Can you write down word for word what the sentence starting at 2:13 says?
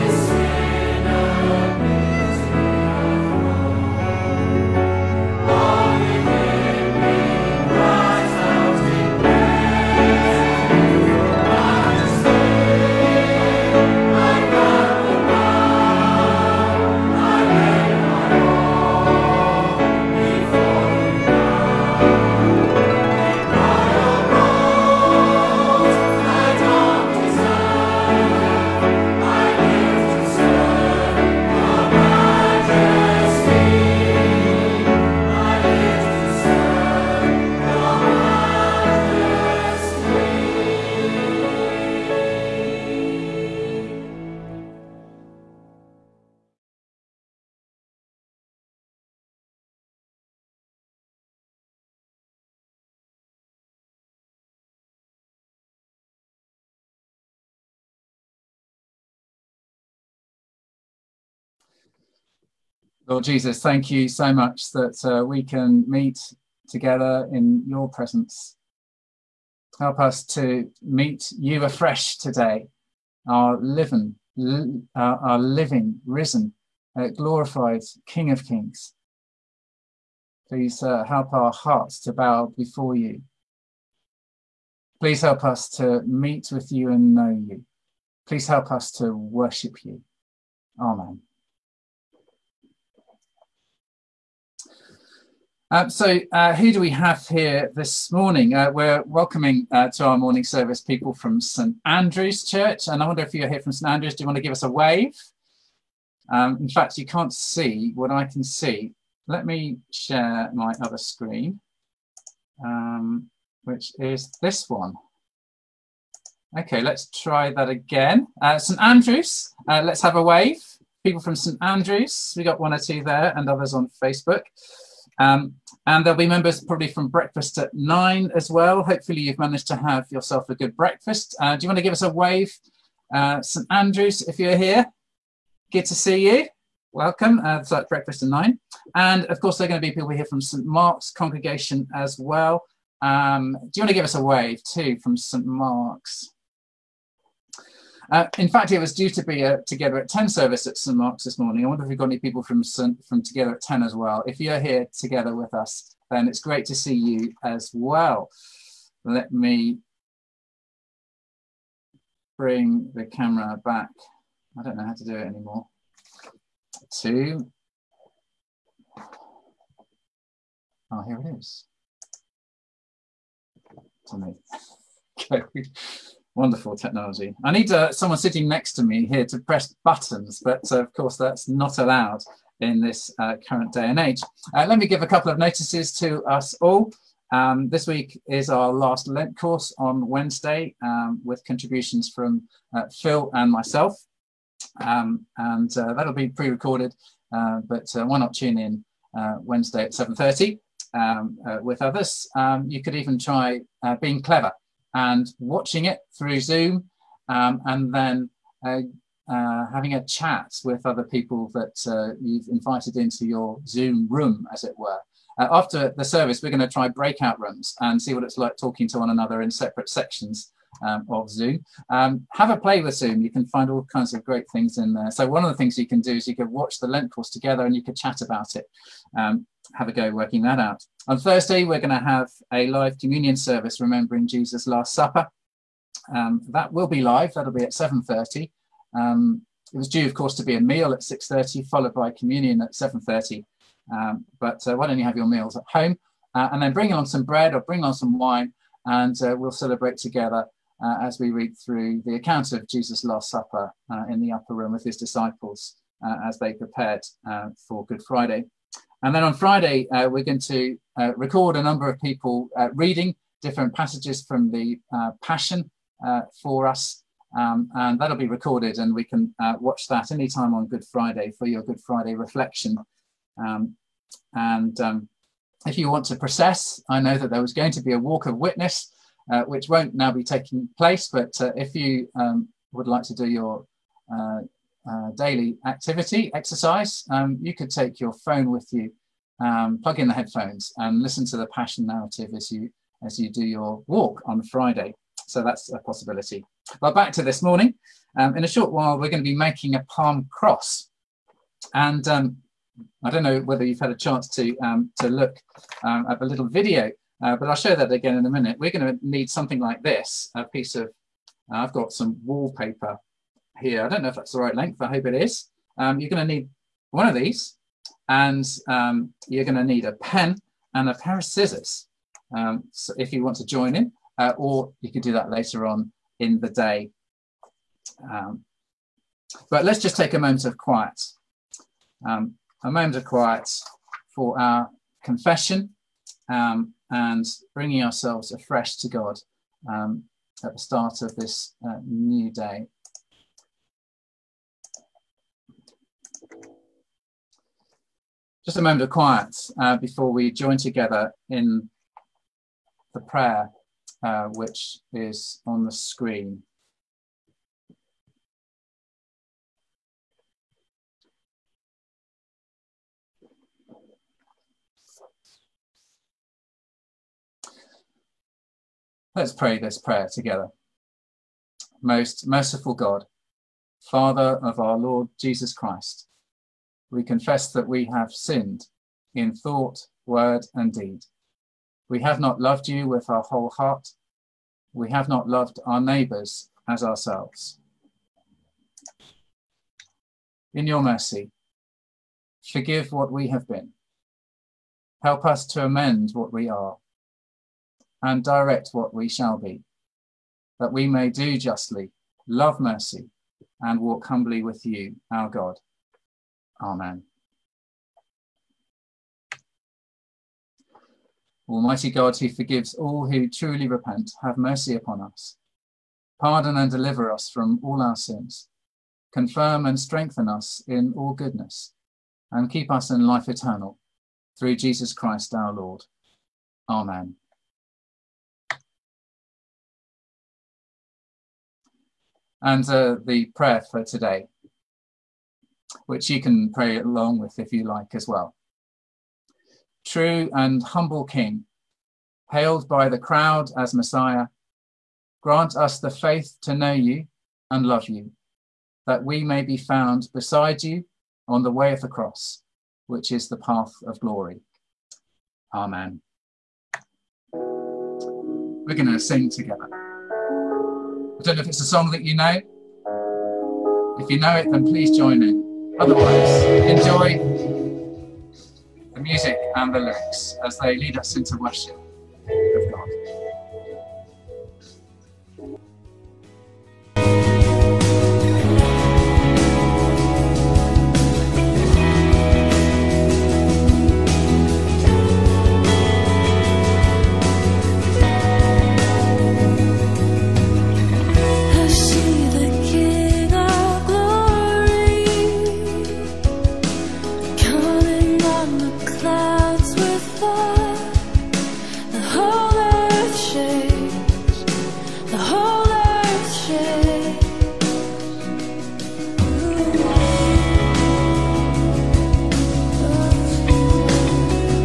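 Uh, St Andrews, if you're here, good to see you.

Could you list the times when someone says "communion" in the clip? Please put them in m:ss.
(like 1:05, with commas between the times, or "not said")
3:52, 4:02.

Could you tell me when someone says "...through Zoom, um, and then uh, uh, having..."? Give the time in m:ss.
3:26.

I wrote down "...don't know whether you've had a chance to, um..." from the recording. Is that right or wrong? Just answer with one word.
right.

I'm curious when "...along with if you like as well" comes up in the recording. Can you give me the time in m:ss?
7:16.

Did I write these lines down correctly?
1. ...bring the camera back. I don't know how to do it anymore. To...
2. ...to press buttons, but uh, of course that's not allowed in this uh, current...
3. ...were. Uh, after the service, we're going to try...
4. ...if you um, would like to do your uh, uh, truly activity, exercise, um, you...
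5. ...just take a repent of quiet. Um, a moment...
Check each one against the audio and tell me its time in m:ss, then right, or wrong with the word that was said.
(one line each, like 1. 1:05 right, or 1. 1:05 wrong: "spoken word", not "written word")
1. 2:42 right
2. 2:59 right
3. 3:34 right
4. 4:41 wrong: "daily", not "truly"
5. 5:29 wrong: "moment", not "repent".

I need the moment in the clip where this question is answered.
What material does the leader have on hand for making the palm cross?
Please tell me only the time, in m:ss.
5:12.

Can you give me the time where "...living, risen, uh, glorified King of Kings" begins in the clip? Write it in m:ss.
1:15.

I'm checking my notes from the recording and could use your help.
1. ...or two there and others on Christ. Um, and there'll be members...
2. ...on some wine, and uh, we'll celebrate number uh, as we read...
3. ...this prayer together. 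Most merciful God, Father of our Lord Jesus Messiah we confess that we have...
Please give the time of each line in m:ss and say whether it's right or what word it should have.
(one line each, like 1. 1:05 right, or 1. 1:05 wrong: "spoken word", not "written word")
1. 2:02 wrong: "Facebook", not "Christ"
2. 4:07 wrong: "together", not "number"
3. 6:09 wrong: "Christ", not "Messiah".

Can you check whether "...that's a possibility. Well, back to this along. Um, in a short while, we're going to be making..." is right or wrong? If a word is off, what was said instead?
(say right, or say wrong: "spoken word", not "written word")
wrong: "morning", not "along".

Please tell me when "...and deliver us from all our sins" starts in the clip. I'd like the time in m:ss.
6:56.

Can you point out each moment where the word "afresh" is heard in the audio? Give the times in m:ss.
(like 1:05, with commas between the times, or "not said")
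1:11, 5:38.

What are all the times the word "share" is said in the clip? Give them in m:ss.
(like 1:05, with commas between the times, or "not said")
1:49.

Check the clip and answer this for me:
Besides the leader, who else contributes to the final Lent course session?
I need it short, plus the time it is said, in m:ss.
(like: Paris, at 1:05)
Phil, at 3:12.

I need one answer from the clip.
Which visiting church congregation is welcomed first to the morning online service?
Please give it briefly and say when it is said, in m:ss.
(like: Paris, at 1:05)
St Andrew's Church, at 1:41.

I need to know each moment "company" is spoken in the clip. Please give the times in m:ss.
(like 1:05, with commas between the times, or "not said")
not said.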